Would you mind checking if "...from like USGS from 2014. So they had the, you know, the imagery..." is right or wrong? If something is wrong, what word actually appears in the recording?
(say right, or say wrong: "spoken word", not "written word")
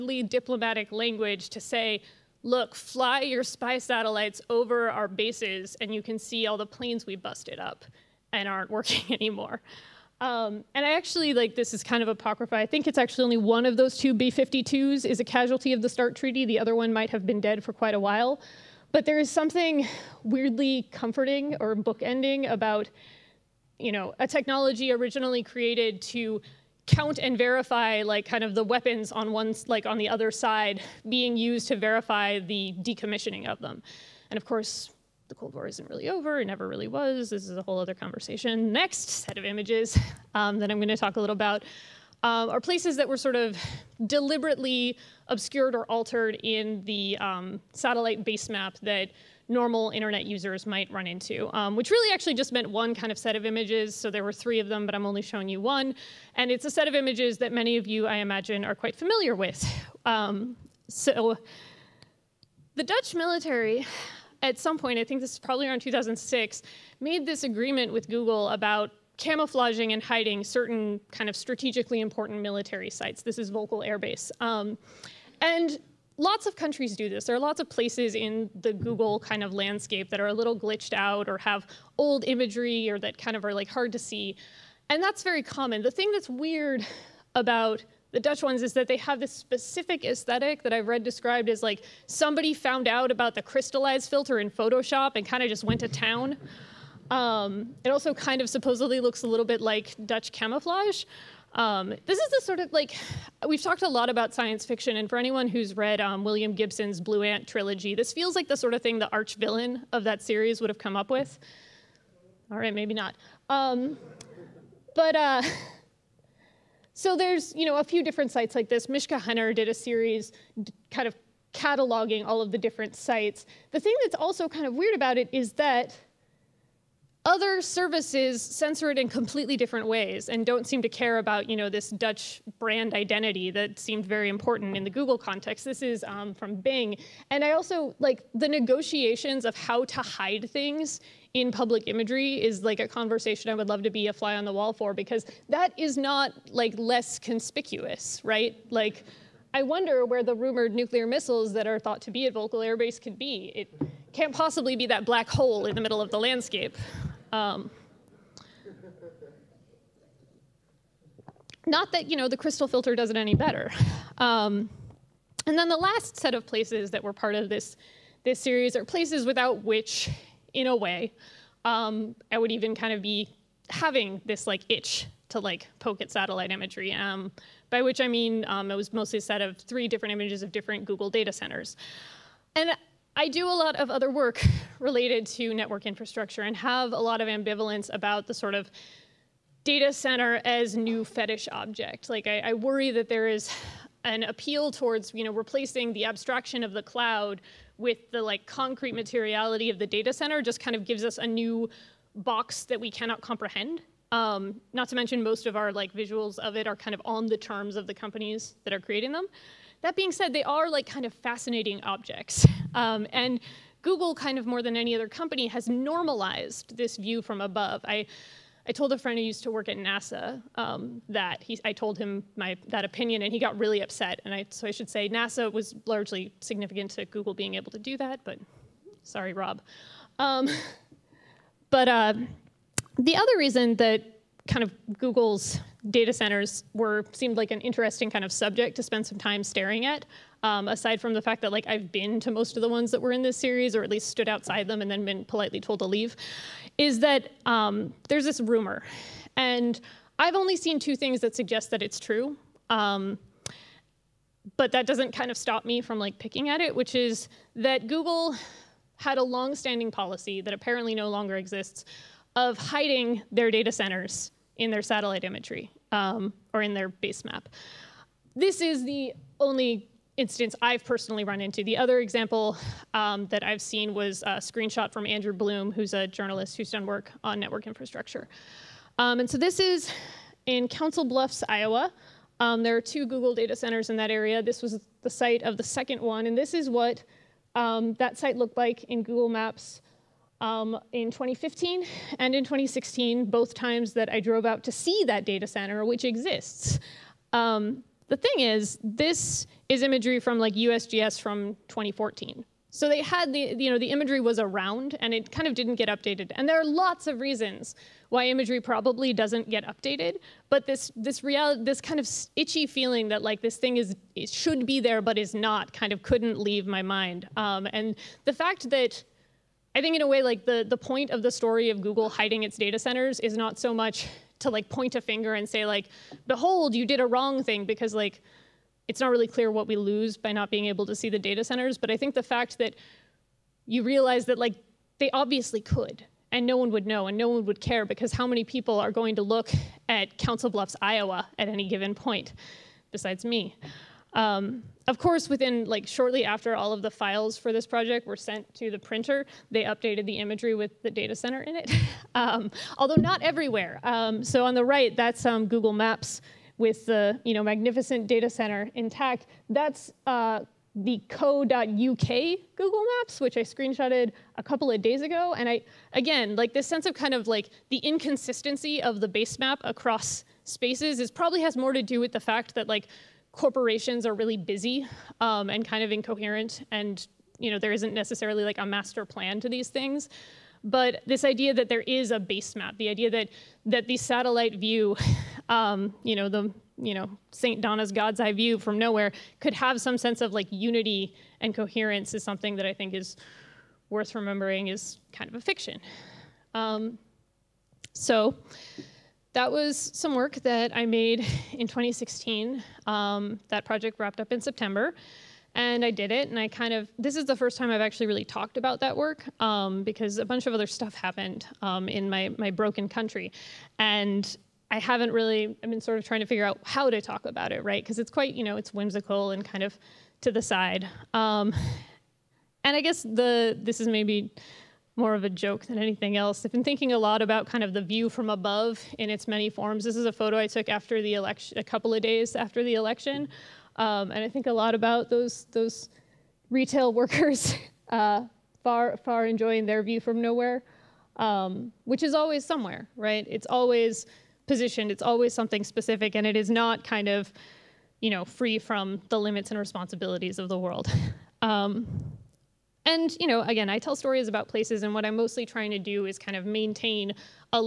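right.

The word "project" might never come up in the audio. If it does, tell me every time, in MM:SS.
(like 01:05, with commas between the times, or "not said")
05:47, 06:43.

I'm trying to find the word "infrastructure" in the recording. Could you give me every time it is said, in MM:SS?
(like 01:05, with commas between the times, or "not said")
03:05, 04:37.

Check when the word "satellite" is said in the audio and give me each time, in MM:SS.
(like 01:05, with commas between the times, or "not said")
00:03, 00:47, 02:56, 04:24, 06:23.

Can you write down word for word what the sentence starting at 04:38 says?
Um, and so this is in Council Bluffs, Iowa.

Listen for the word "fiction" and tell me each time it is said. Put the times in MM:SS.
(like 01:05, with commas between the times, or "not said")
01:44, 06:35.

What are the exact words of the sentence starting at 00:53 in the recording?
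So there were three of them, but I'm only showing you one.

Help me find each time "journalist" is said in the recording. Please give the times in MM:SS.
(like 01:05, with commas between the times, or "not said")
04:36.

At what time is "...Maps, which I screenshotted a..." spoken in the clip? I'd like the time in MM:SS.
06:02.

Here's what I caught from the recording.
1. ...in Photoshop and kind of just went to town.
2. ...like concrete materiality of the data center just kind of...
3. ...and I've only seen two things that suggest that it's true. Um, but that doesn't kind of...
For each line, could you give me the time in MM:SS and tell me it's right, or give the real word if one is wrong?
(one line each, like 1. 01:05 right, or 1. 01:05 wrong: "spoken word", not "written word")
1. 01:34 right
2. 03:18 right
3. 04:09 right.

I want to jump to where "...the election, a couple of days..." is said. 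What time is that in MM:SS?
07:11.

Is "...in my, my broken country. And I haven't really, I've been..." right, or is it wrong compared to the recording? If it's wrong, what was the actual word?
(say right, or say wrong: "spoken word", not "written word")
right.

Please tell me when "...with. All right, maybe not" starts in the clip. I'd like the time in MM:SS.
01:51.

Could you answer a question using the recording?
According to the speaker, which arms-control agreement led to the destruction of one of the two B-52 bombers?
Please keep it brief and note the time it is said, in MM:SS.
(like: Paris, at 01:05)
START Treaty, at 00:15.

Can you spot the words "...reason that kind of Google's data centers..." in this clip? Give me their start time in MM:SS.
03:53.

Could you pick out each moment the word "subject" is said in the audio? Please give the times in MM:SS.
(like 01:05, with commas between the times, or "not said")
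03:58.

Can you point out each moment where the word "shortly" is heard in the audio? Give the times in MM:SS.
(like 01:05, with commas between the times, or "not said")
05:45.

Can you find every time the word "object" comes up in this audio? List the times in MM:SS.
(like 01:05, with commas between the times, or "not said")
03:11, 03:31.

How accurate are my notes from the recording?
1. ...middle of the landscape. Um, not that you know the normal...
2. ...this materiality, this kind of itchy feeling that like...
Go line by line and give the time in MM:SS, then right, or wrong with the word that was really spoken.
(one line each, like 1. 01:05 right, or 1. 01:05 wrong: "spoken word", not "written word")
1. 02:35 wrong: "crystal", not "normal"
2. 05:10 wrong: "reality", not "materiality".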